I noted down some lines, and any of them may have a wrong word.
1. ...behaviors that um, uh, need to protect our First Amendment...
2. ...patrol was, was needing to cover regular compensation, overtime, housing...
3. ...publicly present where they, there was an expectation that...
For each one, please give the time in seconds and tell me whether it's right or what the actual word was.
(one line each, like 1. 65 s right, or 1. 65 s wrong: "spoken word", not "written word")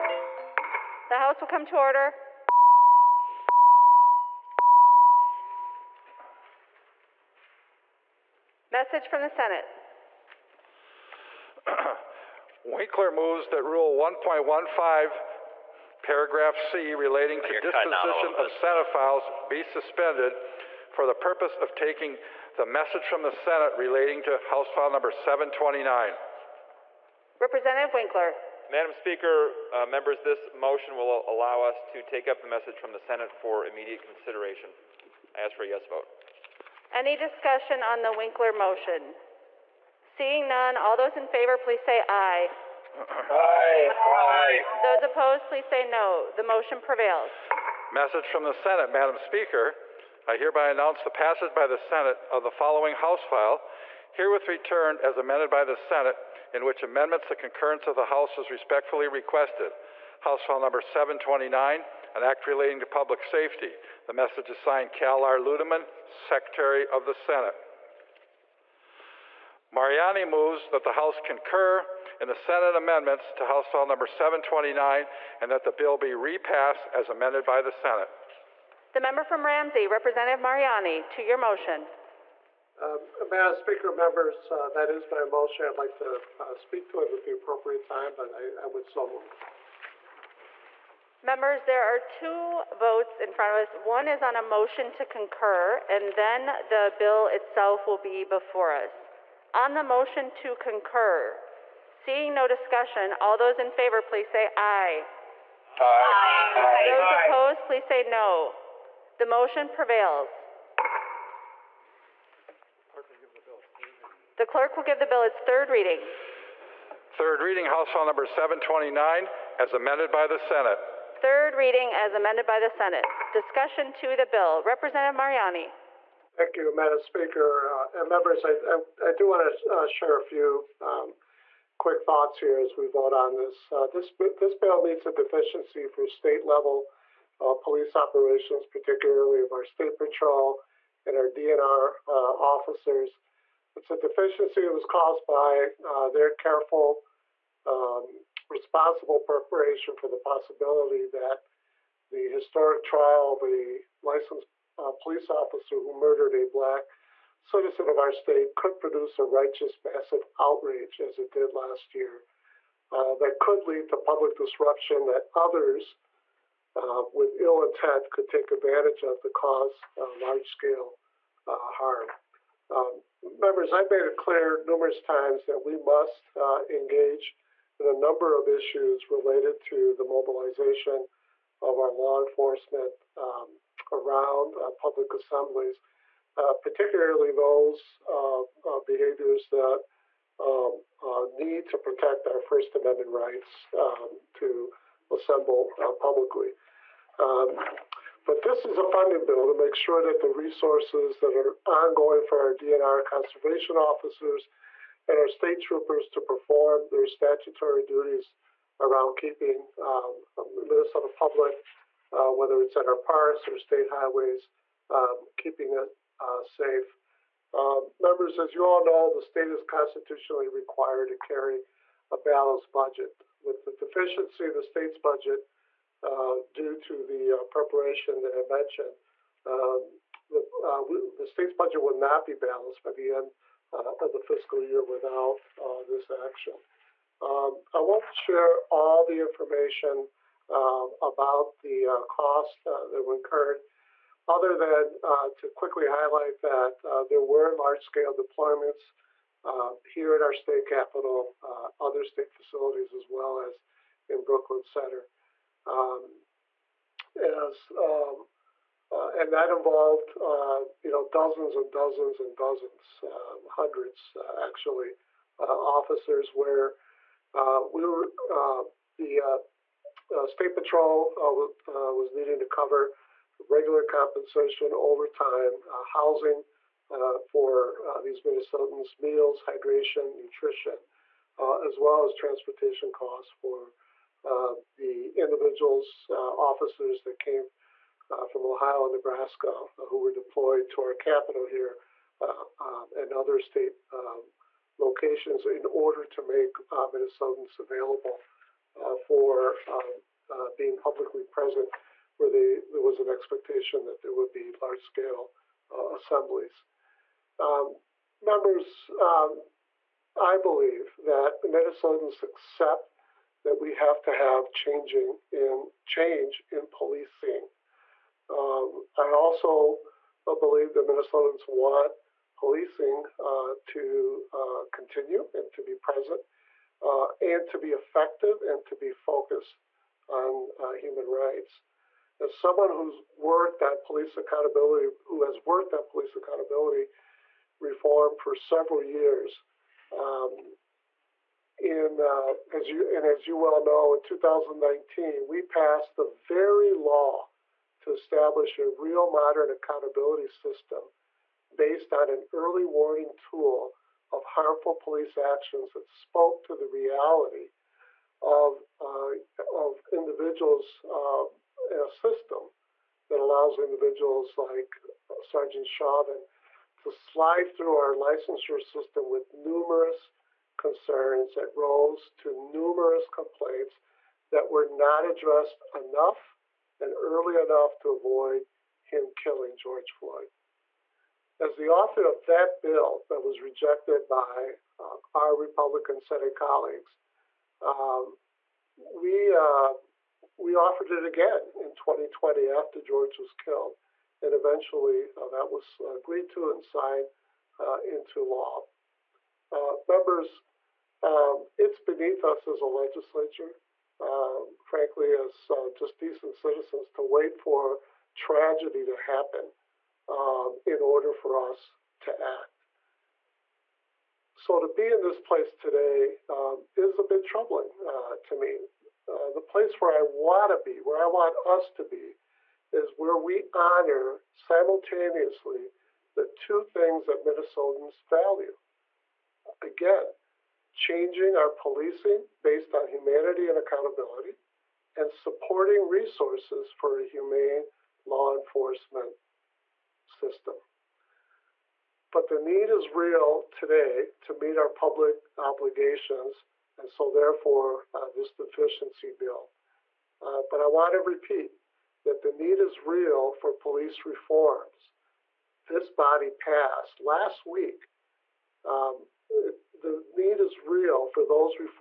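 1. 188 s right
2. 270 s right
3. 300 s right.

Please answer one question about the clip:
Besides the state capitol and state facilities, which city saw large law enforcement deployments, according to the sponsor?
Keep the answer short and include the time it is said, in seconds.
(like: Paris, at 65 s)
Brooklyn Center, at 254 s.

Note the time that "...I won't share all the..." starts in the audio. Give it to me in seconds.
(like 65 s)
237 s.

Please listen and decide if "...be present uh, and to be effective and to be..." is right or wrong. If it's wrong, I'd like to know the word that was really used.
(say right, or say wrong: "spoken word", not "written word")
right.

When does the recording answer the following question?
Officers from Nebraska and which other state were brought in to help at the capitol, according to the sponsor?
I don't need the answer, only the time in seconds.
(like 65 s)
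288 s.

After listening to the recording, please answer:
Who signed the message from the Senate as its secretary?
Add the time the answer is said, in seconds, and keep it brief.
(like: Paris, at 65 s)
Cal R. Ludeman, at 64 s.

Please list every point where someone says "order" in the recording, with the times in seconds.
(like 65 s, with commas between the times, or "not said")
1 s, 295 s, 410 s.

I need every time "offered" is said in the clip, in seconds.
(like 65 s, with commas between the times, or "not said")
390 s.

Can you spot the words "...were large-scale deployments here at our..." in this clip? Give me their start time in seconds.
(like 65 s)
247 s.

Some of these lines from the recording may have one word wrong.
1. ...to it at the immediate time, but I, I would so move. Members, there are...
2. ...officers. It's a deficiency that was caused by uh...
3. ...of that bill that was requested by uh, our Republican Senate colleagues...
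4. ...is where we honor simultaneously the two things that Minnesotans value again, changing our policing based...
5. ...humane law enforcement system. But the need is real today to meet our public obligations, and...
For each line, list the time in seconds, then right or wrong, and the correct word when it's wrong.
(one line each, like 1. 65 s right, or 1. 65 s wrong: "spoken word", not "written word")
1. 86 s wrong: "appropriate", not "immediate"
2. 142 s right
3. 382 s wrong: "rejected", not "requested"
4. 422 s right
5. 437 s right.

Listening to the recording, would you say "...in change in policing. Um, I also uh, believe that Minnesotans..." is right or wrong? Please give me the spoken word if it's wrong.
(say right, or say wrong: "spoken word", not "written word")
right.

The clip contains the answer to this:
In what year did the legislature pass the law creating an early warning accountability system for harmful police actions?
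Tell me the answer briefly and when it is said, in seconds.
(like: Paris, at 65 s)
2019, at 344 s.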